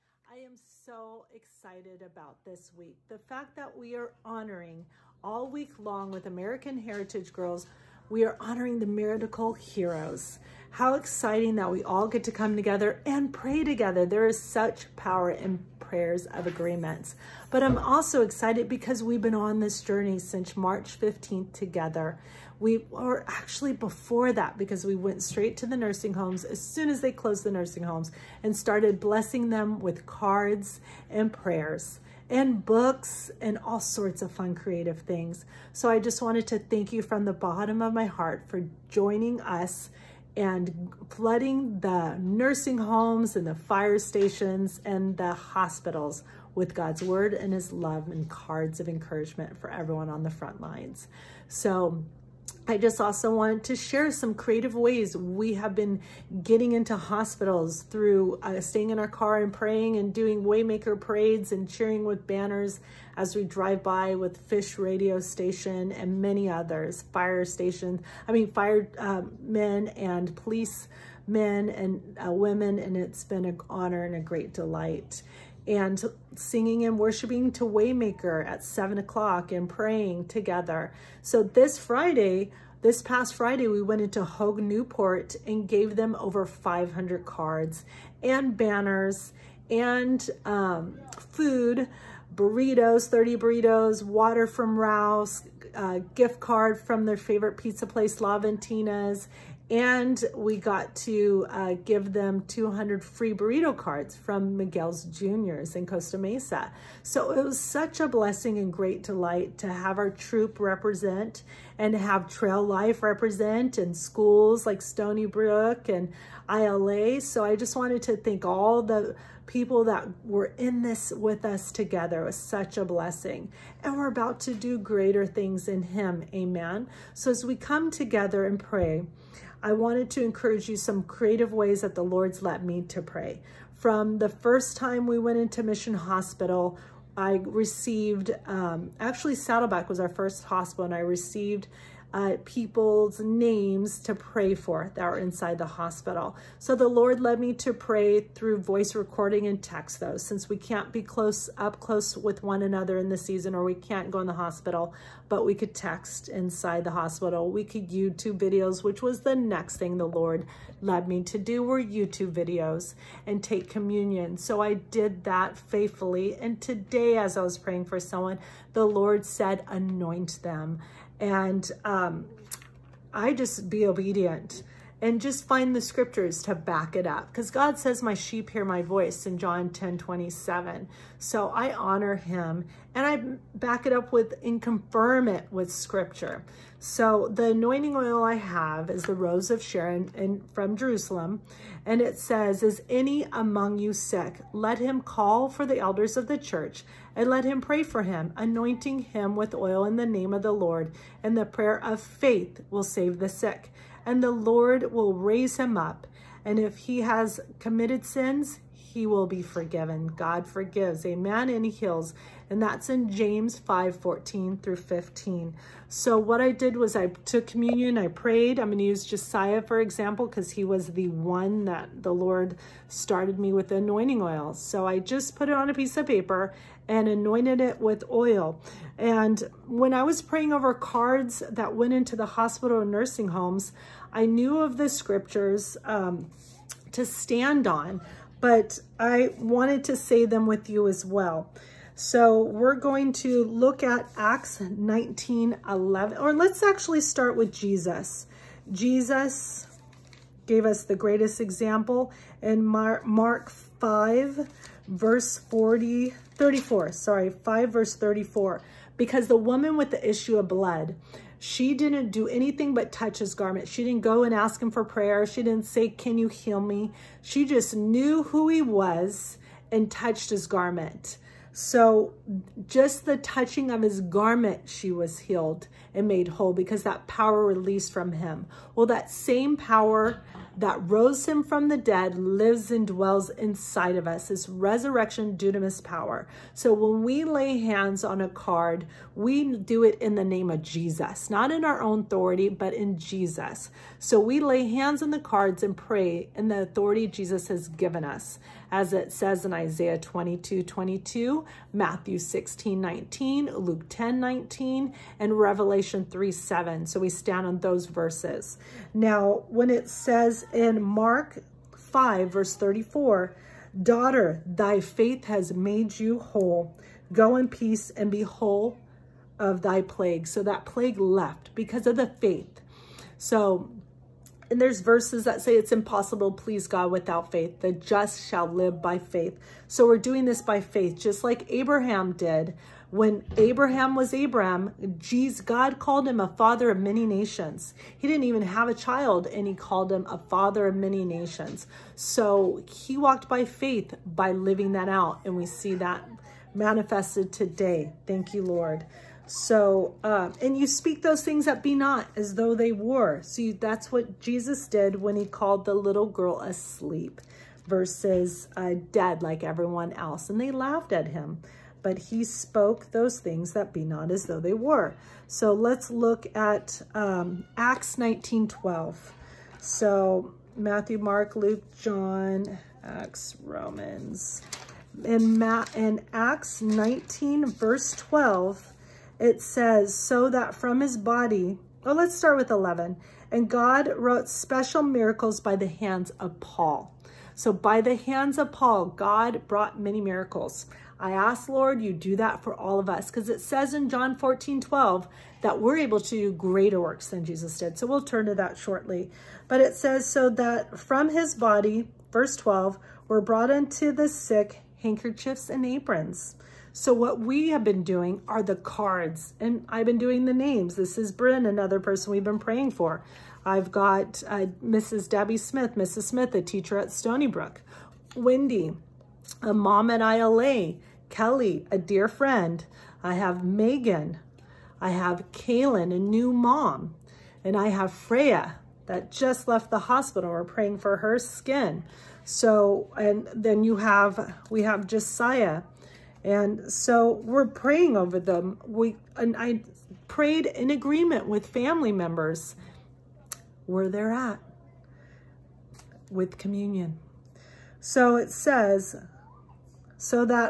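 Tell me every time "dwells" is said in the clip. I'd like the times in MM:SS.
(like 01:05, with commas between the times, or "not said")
04:42.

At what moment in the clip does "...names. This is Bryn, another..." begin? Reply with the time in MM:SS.
06:50.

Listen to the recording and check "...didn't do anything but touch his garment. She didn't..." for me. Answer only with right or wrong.
right.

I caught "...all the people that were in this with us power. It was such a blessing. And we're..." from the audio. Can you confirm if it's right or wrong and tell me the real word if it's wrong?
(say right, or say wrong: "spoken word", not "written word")
wrong: "together", not "power".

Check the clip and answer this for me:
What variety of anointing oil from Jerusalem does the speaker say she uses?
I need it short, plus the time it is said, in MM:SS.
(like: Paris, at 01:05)
Rose of Sharon, at 03:09.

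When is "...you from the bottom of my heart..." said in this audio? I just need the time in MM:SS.
00:36.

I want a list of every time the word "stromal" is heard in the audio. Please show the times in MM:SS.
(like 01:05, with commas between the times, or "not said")
not said.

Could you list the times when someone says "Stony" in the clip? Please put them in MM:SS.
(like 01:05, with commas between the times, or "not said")
01:54, 06:56.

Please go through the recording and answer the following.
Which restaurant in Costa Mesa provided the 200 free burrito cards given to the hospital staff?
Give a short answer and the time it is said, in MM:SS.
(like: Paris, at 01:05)
Miguel's Juniors, at 01:44.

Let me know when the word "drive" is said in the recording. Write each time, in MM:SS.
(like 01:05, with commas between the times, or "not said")
01:03.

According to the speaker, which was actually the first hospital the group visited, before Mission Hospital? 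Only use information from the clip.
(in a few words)
Saddleback.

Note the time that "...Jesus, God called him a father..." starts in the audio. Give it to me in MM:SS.
05:34.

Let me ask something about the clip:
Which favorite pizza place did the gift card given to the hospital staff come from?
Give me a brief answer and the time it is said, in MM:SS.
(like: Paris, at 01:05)
La Ventina's, at 01:38.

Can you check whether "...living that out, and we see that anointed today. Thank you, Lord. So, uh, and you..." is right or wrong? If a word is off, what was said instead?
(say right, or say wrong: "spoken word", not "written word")
wrong: "manifested", not "anointed".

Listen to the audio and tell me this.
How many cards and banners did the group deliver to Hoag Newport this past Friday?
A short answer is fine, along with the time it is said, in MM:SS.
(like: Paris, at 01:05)
over 500, at 01:26.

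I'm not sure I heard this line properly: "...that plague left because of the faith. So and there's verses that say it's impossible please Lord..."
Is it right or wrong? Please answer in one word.
wrong.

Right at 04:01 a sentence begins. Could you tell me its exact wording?
So we're going to look at Acts 19, 11, or let's actually start with Jesus.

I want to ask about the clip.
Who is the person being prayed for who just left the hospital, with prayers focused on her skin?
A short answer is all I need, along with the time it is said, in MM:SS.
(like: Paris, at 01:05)
Freya, at 07:07.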